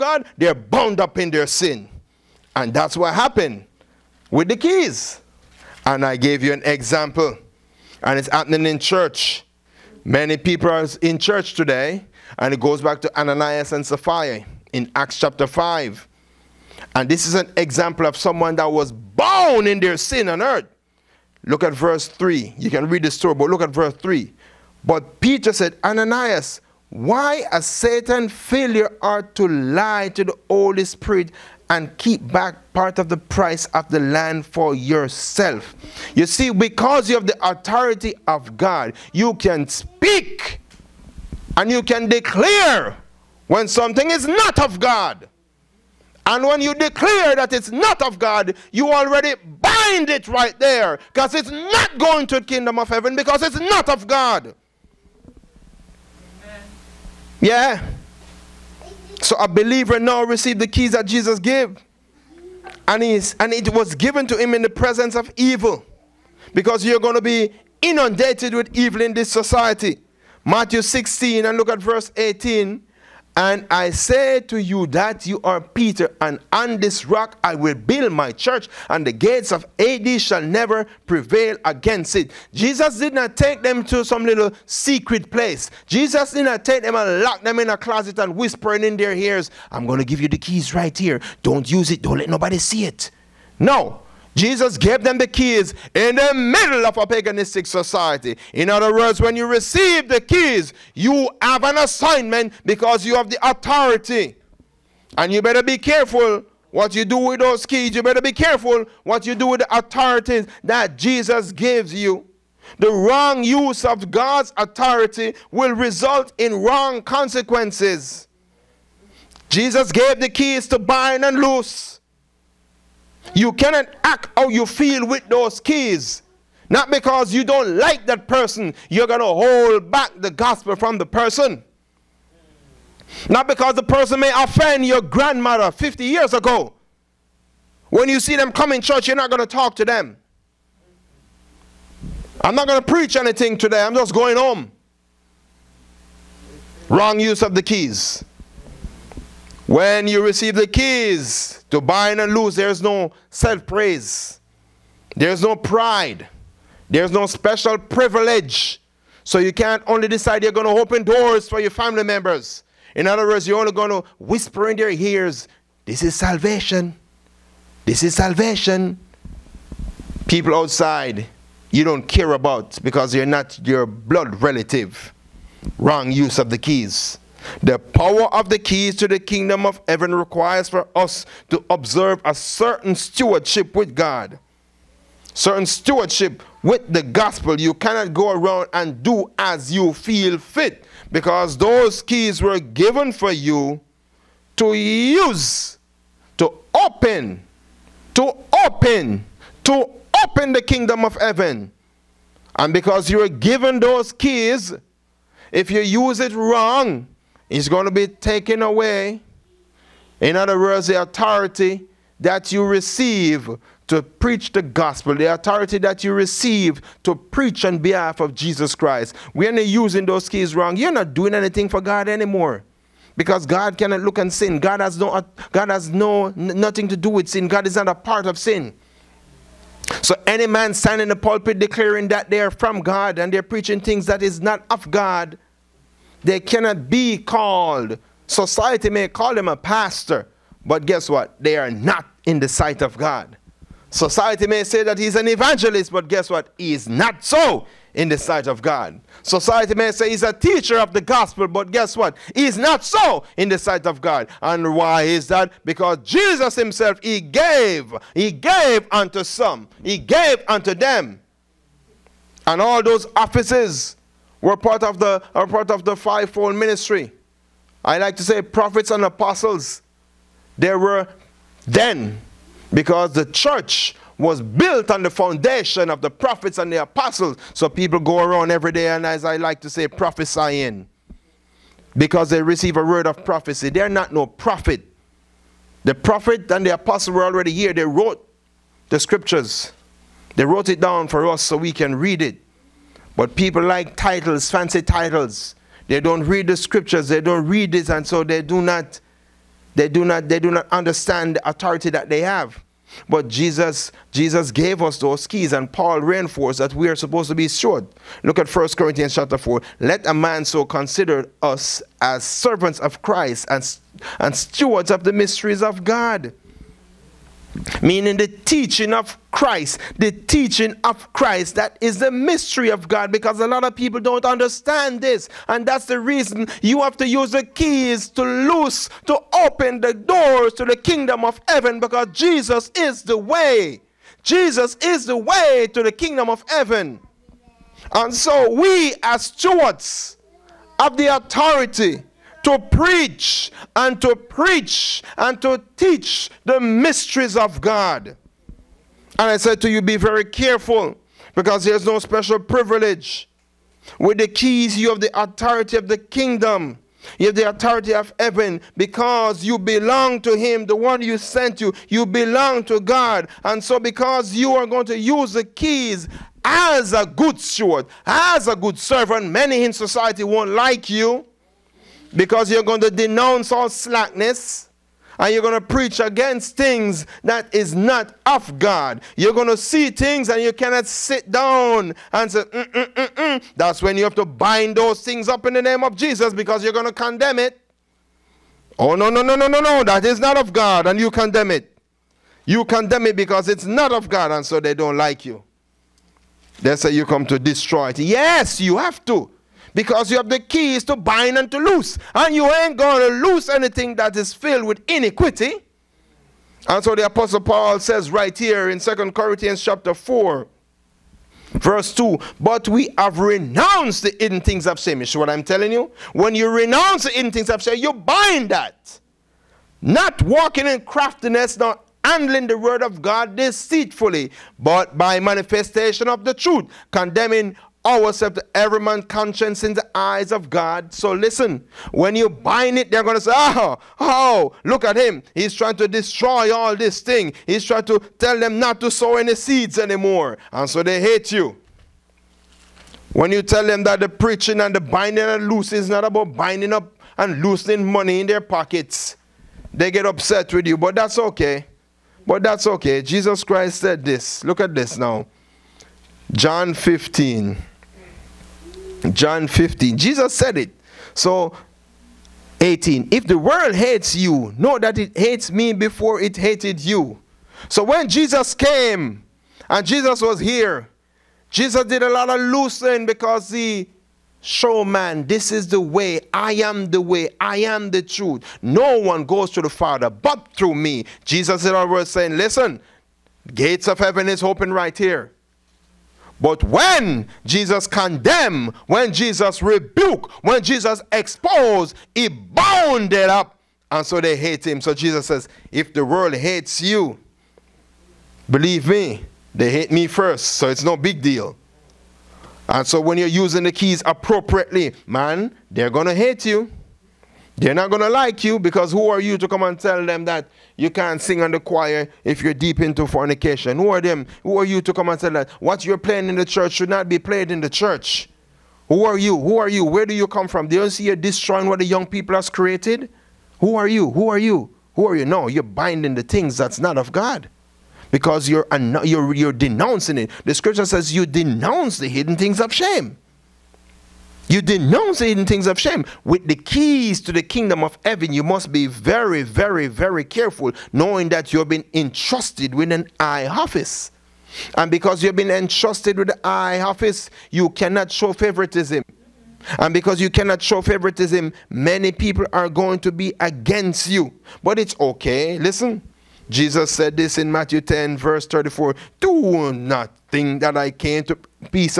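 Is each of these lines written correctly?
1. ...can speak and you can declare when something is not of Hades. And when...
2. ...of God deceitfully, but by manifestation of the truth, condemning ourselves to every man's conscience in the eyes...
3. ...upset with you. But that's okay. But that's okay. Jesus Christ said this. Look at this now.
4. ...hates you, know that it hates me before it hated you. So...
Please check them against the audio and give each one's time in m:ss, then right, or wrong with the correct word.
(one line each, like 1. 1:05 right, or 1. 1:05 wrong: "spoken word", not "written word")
1. 0:39 wrong: "God", not "Hades"
2. 7:02 right
3. 7:30 right
4. 7:43 right.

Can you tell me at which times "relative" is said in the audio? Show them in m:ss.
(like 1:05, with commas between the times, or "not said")
2:54.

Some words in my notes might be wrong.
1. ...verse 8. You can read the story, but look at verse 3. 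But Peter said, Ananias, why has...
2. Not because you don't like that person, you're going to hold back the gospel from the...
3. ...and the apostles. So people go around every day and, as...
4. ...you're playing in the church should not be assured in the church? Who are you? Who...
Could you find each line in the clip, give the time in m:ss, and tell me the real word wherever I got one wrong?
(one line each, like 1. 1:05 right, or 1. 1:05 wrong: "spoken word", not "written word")
1. 0:21 wrong: "3", not "8"
2. 2:06 right
3. 4:36 right
4. 8:35 wrong: "played", not "assured".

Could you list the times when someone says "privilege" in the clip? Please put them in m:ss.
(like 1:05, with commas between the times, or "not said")
2:37, 5:52.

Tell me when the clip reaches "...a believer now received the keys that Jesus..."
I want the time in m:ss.
0:59.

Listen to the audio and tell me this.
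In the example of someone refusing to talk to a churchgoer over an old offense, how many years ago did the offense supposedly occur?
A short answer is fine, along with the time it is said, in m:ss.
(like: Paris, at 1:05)
50, at 2:15.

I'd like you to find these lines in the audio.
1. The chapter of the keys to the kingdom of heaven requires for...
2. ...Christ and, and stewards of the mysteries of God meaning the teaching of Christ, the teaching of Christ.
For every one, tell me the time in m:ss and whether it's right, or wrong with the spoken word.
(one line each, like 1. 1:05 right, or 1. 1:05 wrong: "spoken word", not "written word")
1. 2:57 wrong: "power", not "chapter"
2. 5:13 right.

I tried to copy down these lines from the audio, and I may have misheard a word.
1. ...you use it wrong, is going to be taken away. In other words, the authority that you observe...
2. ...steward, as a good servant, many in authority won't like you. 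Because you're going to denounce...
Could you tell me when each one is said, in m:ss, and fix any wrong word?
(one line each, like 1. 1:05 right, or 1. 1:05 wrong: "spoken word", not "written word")
1. 3:25 wrong: "receive", not "observe"
2. 6:07 wrong: "society", not "authority".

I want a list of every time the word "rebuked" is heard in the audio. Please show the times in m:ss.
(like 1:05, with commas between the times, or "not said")
8:09.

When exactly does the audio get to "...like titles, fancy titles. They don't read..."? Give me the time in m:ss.
4:53.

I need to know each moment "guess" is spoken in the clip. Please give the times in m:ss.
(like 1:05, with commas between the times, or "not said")
4:00, 4:06, 4:11.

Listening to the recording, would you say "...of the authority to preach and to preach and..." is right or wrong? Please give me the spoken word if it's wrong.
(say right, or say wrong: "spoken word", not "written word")
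right.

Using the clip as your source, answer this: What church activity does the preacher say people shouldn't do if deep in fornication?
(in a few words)
Sing on the choir.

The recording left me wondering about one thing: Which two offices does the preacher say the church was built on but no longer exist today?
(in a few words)
Prophets and apostles.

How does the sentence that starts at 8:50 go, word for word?
The scripture says you denounce the hidden things of shame.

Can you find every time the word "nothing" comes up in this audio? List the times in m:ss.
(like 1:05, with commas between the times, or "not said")
3:46.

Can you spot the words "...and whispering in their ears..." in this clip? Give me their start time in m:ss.
1:28.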